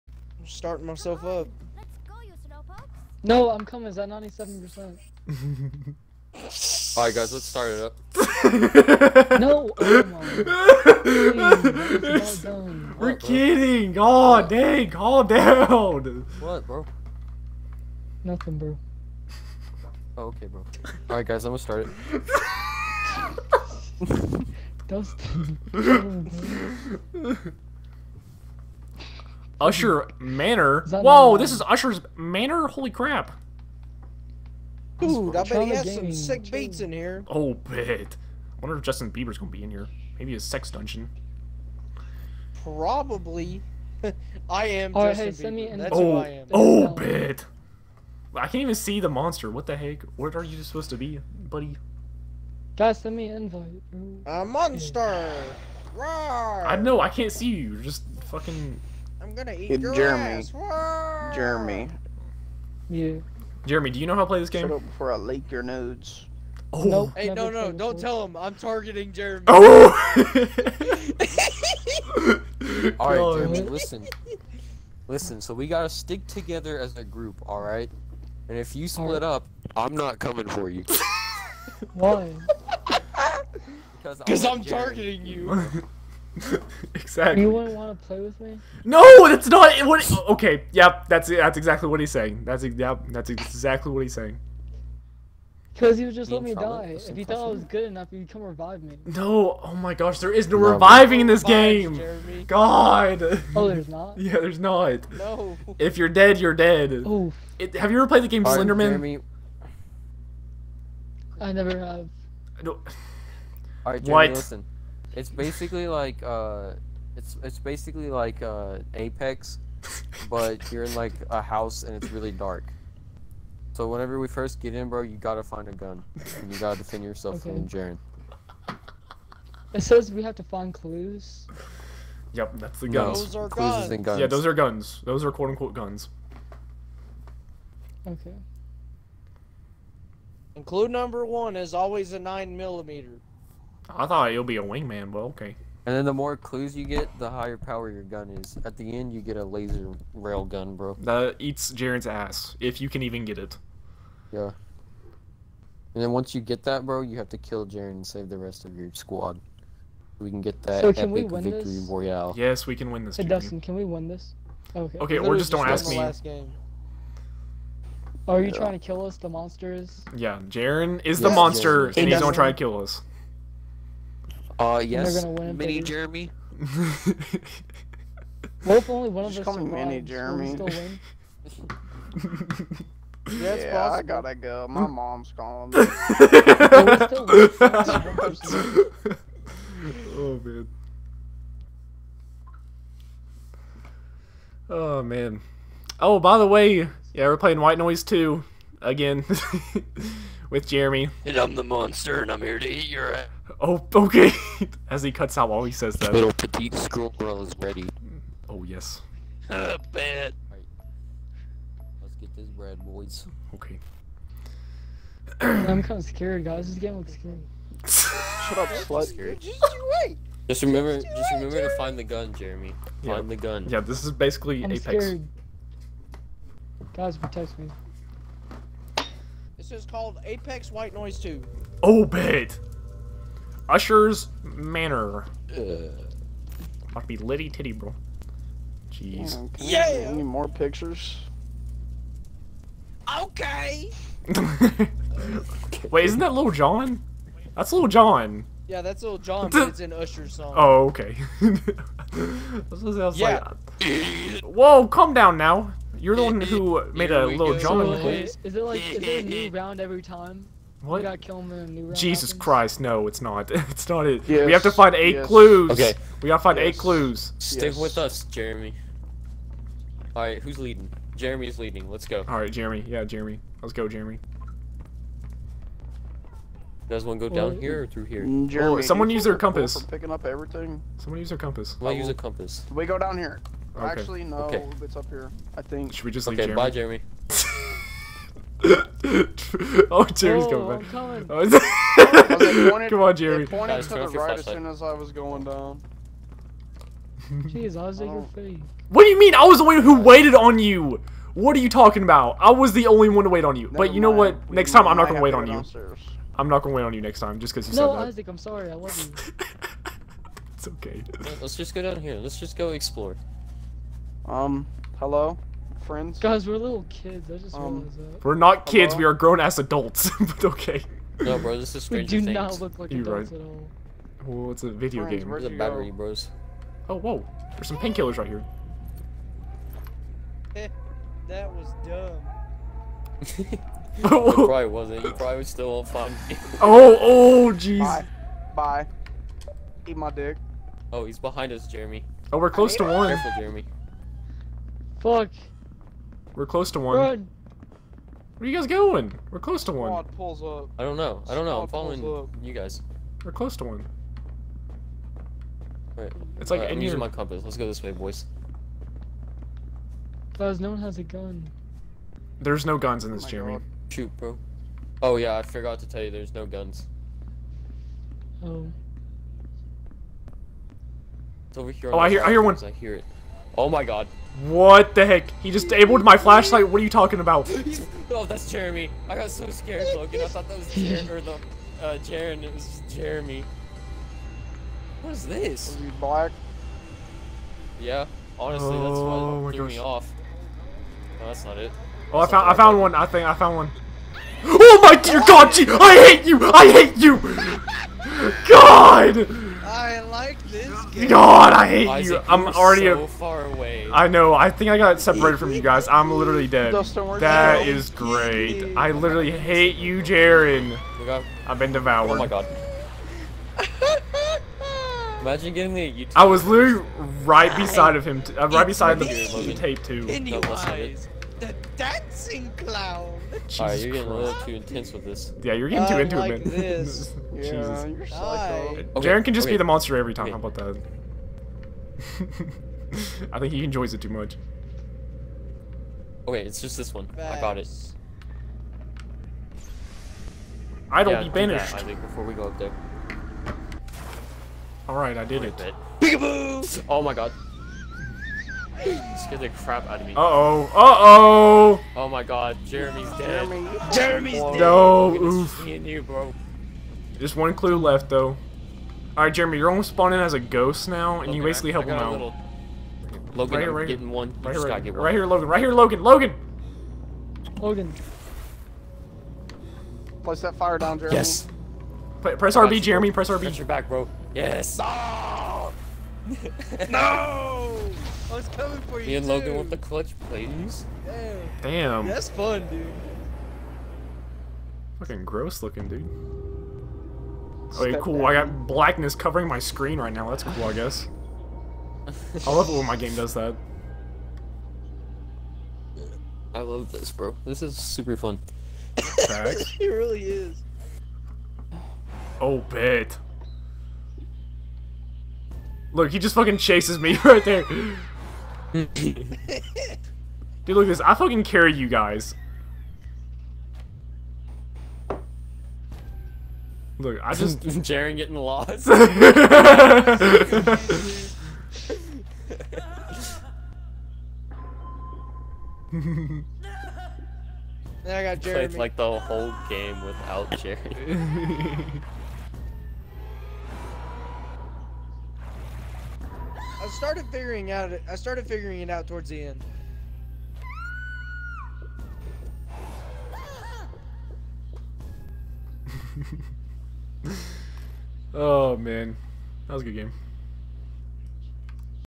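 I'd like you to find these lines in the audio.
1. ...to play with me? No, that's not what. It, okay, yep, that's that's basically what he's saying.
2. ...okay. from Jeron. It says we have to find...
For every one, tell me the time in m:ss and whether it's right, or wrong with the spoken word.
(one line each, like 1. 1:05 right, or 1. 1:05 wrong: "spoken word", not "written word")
1. 1:27 wrong: "exactly", not "basically"
2. 2:07 right.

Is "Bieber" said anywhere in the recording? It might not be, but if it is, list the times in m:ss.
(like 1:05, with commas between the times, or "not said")
0:39, 0:45.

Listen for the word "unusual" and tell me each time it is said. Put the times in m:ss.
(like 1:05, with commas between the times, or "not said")
not said.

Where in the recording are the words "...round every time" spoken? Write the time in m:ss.
4:19.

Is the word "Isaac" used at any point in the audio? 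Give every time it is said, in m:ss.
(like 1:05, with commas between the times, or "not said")
5:08, 6:41.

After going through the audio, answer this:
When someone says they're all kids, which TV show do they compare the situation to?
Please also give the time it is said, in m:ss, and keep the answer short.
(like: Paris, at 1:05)
Stranger Things, at 5:21.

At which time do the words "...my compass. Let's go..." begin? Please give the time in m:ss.
5:56.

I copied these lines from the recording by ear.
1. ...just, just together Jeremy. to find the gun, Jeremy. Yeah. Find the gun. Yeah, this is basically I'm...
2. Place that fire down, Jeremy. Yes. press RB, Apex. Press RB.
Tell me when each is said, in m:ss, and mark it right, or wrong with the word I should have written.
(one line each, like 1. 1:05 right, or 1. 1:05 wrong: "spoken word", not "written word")
1. 3:41 wrong: "remember", not "together"
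2. 7:50 wrong: "Jeremy", not "Apex".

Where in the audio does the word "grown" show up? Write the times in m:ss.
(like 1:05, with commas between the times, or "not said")
5:19.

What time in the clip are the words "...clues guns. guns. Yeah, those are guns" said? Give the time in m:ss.
2:13.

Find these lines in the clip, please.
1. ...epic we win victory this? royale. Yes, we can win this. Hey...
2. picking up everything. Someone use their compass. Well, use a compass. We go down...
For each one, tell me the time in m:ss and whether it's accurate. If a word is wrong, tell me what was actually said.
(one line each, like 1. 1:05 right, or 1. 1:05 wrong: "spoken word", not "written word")
1. 2:41 right
2. 4:39 right.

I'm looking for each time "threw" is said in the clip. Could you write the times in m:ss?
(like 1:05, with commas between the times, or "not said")
6:29.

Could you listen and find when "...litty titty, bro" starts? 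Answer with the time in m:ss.
3:57.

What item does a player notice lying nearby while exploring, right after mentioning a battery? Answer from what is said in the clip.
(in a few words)
painkillers.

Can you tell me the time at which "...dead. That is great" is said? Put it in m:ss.
6:46.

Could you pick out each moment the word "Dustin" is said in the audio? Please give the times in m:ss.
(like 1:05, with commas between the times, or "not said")
0:24, 2:43, 2:52.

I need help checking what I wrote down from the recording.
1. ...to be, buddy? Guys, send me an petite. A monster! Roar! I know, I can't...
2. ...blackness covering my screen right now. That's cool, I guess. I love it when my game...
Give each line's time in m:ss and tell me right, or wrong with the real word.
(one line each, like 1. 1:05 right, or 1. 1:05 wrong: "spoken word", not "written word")
1. 0:50 wrong: "invite", not "petite"
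2. 8:08 right.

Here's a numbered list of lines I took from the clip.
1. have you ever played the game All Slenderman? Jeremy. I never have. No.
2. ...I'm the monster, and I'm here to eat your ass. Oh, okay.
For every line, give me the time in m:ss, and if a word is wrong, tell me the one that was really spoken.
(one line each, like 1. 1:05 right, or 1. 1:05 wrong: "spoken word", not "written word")
1. 1:47 right
2. 3:21 right.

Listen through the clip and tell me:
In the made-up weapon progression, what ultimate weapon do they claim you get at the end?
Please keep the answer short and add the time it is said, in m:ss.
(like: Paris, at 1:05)
laser rail gun, at 2:29.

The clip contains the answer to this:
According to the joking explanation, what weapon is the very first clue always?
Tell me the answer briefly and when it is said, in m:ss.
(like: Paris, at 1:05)
nine millimeter, at 2:22.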